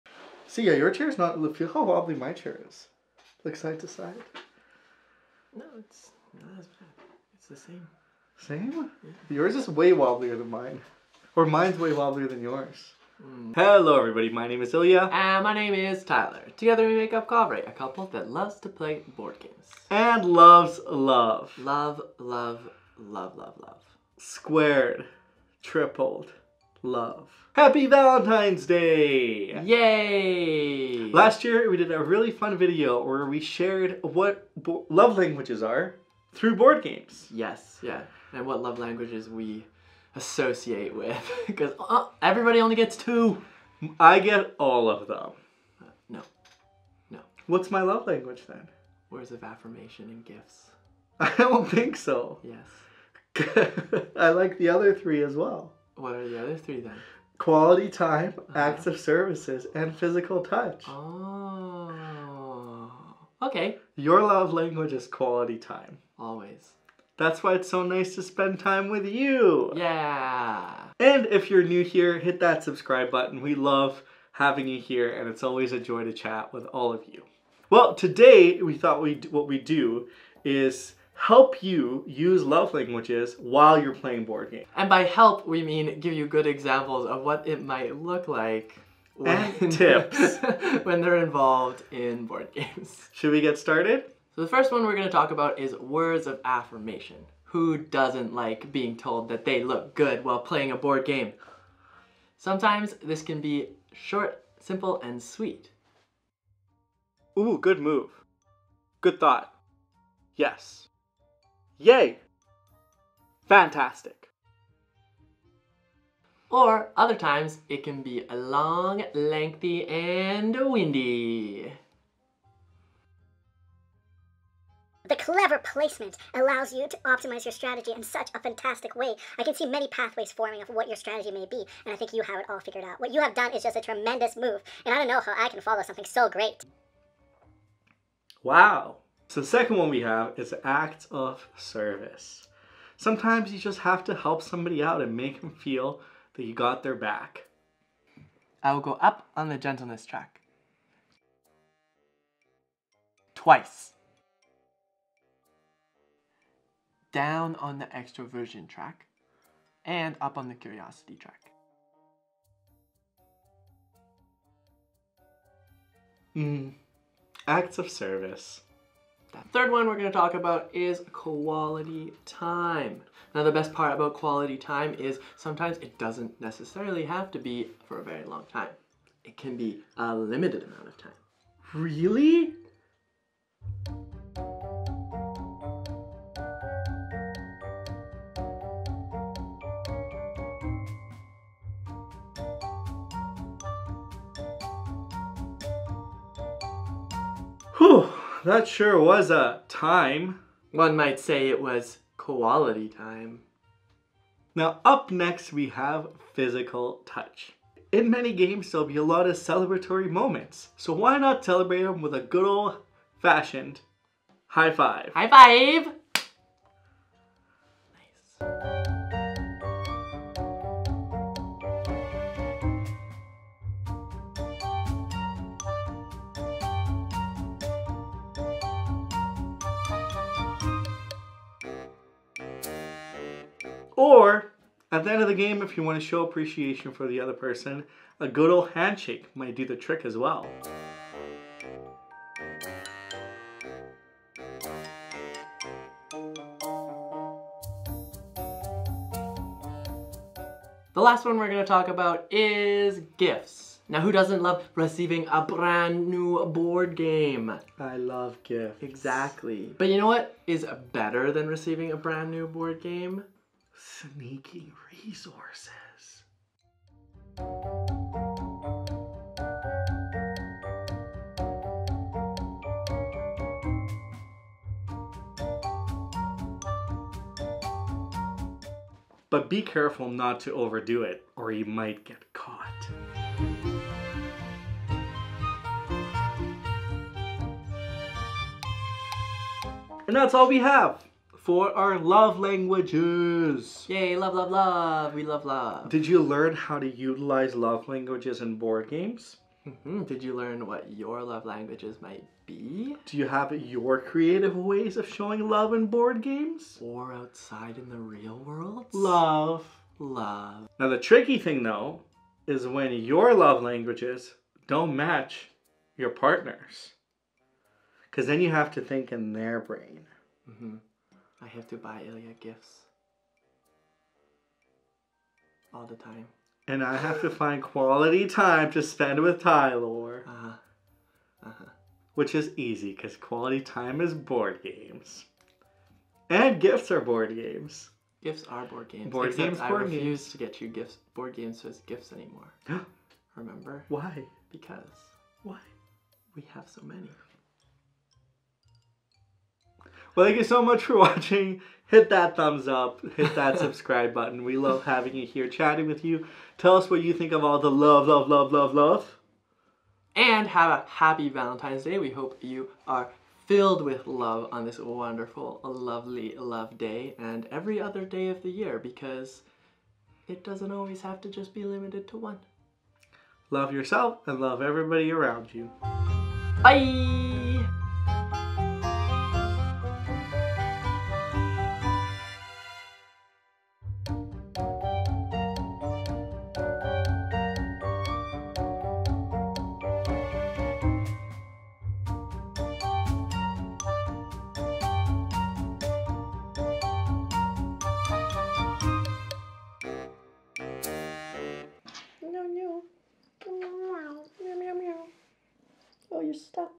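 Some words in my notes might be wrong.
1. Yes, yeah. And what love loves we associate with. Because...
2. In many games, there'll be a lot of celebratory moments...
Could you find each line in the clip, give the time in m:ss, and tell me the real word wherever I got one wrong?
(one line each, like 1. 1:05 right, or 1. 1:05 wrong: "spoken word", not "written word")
1. 0:37 wrong: "languages", not "loves"
2. 3:27 right.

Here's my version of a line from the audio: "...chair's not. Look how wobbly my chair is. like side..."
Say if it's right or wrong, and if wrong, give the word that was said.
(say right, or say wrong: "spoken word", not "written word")
right.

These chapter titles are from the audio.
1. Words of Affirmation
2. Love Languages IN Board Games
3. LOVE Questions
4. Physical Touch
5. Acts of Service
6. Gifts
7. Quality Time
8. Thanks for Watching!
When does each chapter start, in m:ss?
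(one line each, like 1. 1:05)
1. 1:34
2. 1:17
3. 4:50
4. 3:24
5. 2:19
6. 4:11
7. 2:49
8. 5:50.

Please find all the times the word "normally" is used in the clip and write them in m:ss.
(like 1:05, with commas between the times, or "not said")
not said.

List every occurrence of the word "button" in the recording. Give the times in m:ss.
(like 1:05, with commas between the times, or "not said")
1:13, 5:54.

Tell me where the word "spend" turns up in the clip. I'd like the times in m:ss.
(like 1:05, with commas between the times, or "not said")
1:08, 5:28.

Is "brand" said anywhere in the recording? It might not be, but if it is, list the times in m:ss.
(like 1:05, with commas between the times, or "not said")
4:15, 4:21.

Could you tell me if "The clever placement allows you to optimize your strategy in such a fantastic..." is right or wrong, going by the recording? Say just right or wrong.
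right.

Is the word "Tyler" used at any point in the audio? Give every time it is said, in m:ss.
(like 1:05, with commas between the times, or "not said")
0:16, 5:29.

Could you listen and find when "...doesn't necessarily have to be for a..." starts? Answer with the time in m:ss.
2:55.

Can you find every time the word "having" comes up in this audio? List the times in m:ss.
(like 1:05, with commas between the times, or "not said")
1:14, 5:54.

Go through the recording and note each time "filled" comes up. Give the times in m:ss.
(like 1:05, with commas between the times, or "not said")
6:03.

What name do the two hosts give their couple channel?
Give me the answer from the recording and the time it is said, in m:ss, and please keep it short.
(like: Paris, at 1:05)
Kovray, at 0:17.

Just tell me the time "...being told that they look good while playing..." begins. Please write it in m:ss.
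1:38.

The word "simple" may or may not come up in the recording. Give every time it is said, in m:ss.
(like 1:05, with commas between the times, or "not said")
1:44.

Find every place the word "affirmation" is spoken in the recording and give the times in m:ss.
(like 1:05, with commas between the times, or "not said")
0:49, 1:36.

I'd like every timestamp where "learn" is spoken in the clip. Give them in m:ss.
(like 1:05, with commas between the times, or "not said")
4:56, 5:00.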